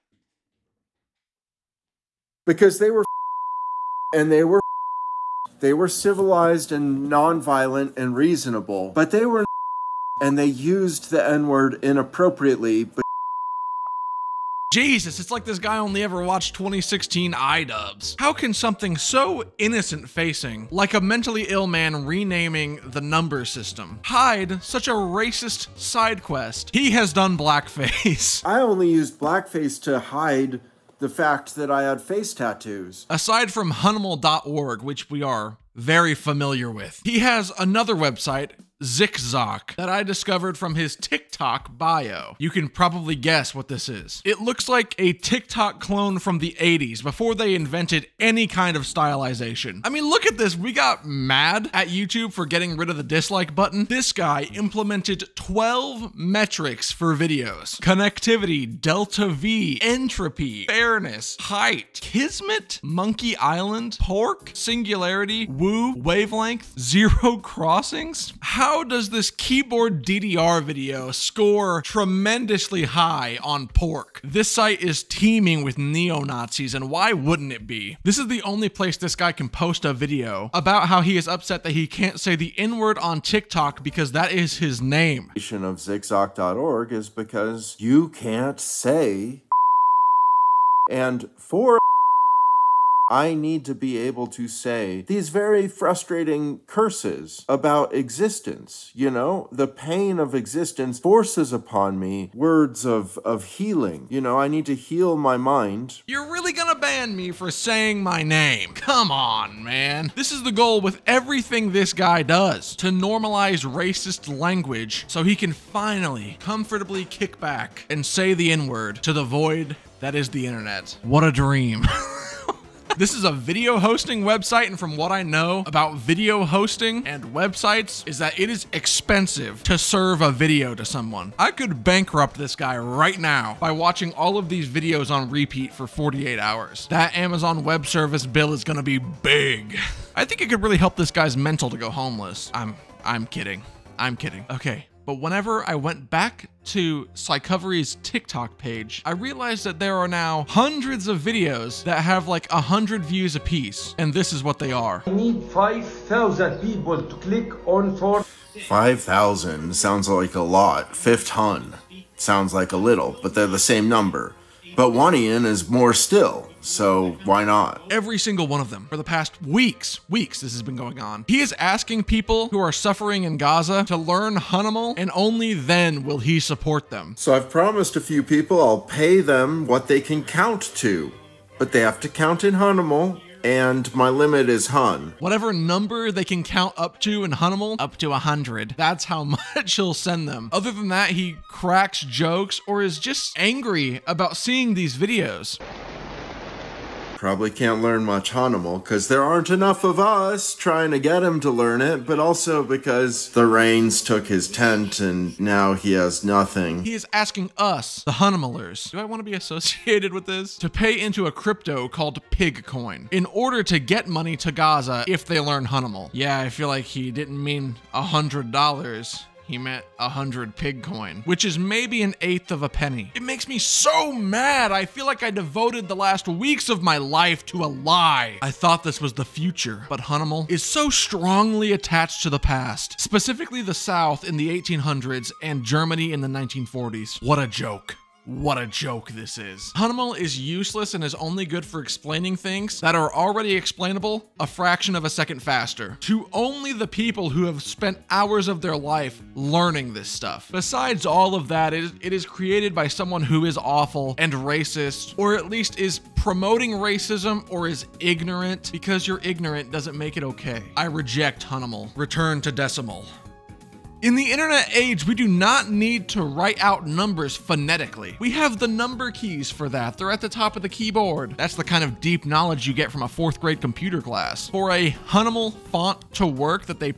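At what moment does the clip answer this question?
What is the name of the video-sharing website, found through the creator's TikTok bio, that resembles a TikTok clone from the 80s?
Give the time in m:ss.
0:38.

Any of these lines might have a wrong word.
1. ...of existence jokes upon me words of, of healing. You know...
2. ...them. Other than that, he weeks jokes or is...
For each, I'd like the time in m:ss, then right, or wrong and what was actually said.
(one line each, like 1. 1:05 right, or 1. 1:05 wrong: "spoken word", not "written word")
1. 1:40 wrong: "forces", not "jokes"
2. 3:10 wrong: "cracks", not "weeks".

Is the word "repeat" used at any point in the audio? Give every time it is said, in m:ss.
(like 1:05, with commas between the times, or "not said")
2:15.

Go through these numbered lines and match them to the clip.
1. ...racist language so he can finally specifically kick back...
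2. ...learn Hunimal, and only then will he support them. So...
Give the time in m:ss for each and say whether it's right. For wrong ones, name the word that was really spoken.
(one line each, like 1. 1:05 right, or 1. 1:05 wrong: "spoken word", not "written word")
1. 1:53 wrong: "comfortably", not "specifically"
2. 2:53 right.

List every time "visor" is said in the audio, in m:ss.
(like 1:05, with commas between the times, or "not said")
not said.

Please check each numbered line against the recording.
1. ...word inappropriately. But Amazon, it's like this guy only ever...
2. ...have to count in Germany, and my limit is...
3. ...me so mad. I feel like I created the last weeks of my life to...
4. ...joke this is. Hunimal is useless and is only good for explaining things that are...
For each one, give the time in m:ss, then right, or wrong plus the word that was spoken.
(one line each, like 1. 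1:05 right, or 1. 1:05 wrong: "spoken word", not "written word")
1. 0:11 wrong: "Jesus", not "Amazon"
2. 3:01 wrong: "Hunimal", not "Germany"
3. 3:43 wrong: "devoted", not "created"
4. 3:58 right.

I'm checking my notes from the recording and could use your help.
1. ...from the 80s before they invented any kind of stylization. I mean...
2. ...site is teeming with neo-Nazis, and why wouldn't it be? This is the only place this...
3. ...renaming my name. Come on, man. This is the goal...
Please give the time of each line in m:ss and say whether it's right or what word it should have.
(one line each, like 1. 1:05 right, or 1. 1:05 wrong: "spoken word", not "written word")
1. 0:46 right
2. 1:14 right
3. 1:47 wrong: "saying", not "renaming".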